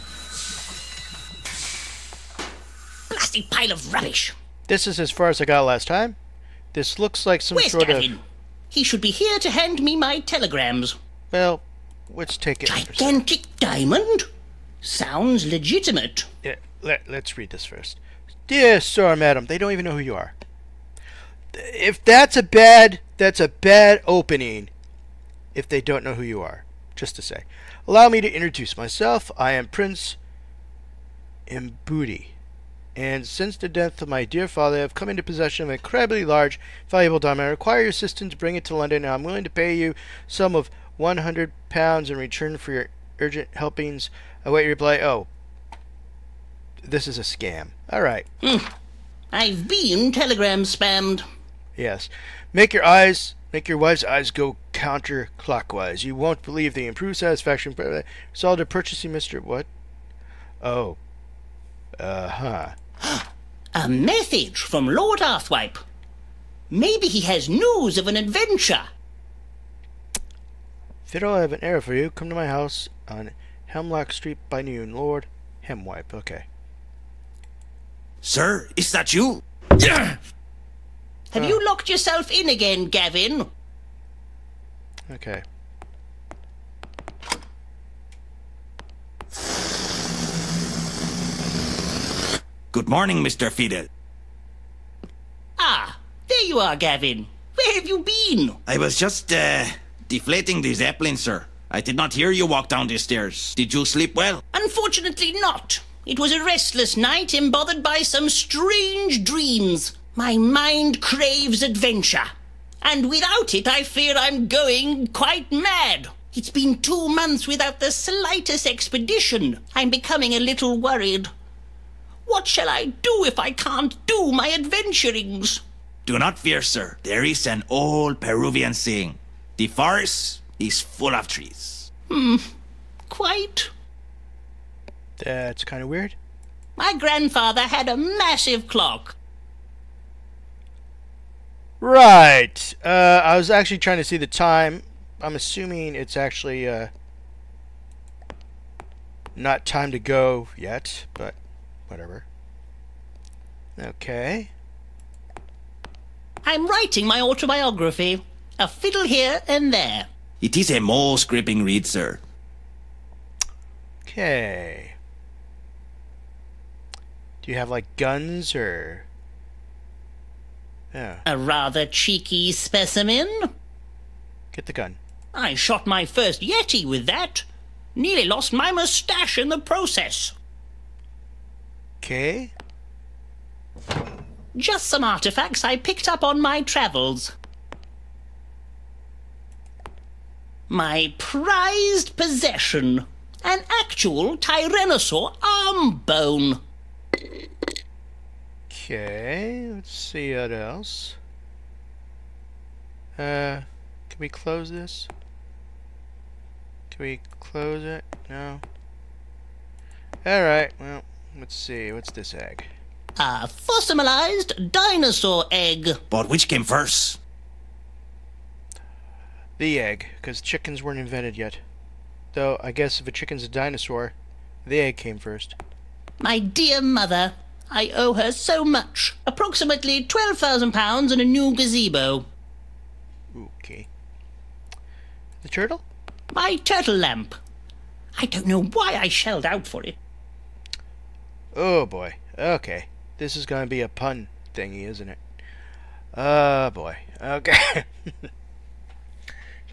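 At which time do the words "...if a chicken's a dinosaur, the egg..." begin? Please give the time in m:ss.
3:42.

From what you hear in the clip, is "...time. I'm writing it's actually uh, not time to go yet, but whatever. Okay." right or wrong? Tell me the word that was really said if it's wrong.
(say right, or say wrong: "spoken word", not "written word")
wrong: "assuming", not "writing".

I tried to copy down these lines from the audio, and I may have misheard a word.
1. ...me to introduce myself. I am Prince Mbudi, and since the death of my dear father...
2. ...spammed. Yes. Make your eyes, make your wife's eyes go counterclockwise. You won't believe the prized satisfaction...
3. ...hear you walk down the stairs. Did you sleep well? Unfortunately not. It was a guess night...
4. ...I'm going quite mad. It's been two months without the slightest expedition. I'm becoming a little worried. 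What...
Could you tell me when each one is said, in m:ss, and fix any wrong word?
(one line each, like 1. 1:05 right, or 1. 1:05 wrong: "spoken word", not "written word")
1. 0:28 right
2. 0:50 wrong: "improved", not "prized"
3. 1:42 wrong: "restless", not "guess"
4. 1:54 right.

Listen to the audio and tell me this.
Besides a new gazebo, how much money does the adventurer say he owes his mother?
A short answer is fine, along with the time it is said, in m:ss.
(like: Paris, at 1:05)
£12,000, at 3:50.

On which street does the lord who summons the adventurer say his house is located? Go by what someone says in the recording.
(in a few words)
Hemlock Street.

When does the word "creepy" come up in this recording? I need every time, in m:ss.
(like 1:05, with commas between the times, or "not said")
not said.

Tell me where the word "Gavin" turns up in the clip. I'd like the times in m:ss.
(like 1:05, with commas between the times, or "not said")
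0:07, 1:22, 1:36.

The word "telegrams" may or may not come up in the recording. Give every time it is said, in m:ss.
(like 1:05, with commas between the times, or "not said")
0:10, 0:50.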